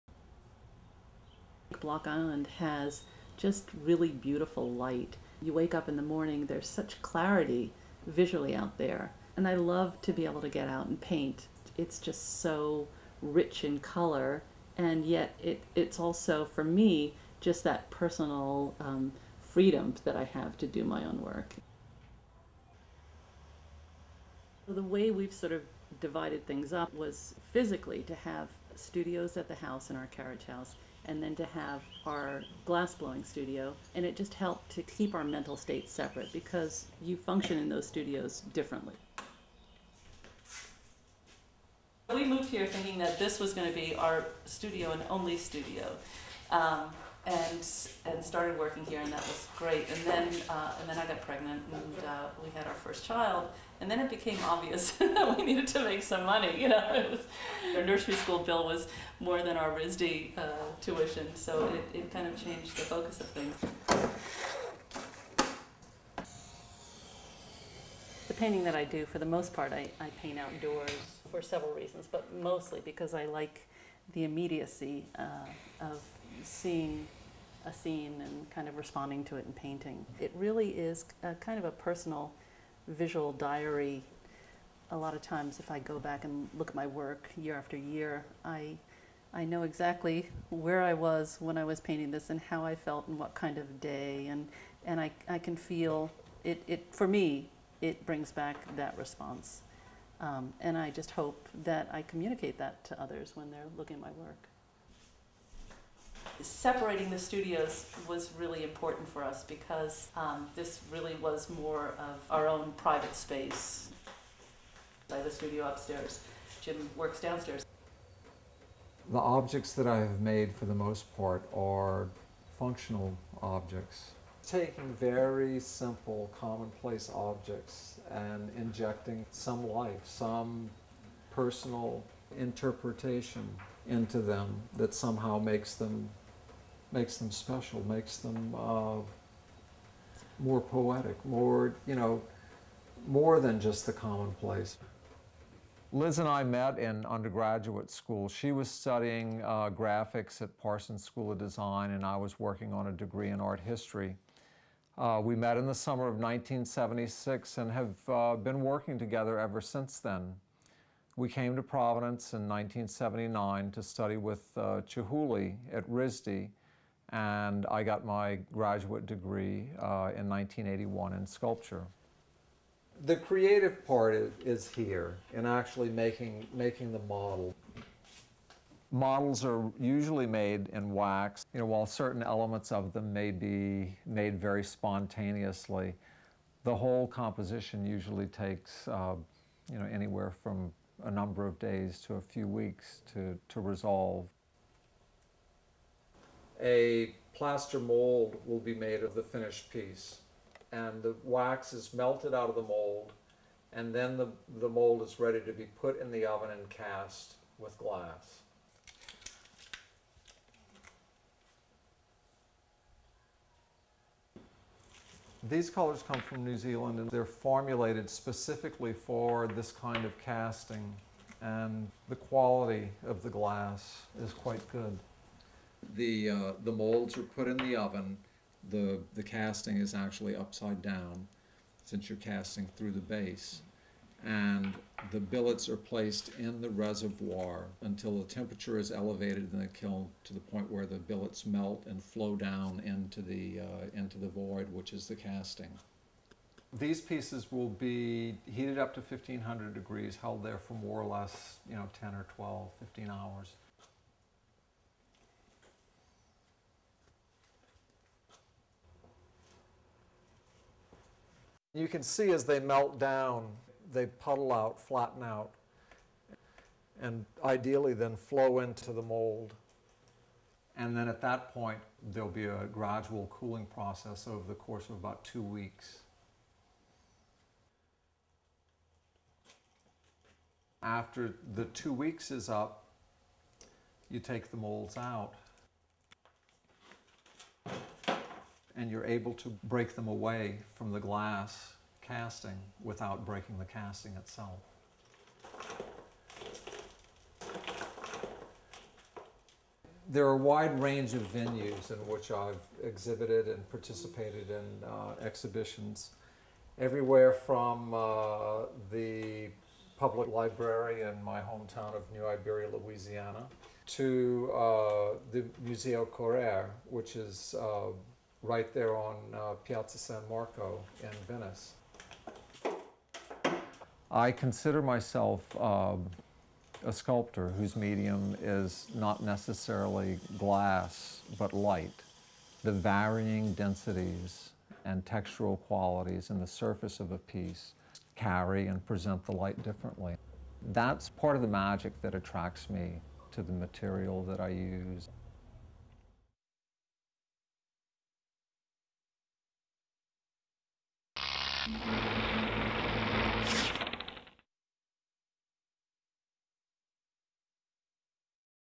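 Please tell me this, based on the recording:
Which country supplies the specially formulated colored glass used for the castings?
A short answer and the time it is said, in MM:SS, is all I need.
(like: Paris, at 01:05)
New Zealand, at 03:36.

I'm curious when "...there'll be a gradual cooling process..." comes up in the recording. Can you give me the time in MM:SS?
04:32.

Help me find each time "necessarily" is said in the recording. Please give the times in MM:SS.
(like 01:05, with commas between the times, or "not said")
05:29.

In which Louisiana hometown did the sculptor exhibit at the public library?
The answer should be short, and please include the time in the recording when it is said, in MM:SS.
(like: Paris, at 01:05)
New Iberia, at 05:12.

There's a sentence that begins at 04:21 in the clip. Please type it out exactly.
You can see as they melt down, they puddle out, flatten out, and ideally then flow into the mold.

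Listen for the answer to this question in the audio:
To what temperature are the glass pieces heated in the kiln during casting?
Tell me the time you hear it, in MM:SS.
04:09.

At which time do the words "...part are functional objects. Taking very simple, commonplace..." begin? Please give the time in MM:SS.
02:01.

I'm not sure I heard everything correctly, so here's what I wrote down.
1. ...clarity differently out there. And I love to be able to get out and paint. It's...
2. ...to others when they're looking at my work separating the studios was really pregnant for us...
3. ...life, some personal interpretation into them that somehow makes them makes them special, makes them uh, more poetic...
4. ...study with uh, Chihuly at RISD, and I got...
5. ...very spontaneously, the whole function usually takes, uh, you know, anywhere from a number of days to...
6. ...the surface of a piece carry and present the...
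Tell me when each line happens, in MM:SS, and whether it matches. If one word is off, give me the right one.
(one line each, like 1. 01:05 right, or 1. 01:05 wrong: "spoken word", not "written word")
1. 00:07 wrong: "visually", not "differently"
2. 01:42 wrong: "important", not "pregnant"
3. 02:09 right
4. 02:43 right
5. 03:04 wrong: "composition", not "function"
6. 05:36 right.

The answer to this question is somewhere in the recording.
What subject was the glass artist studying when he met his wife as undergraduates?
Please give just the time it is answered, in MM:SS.
02:33.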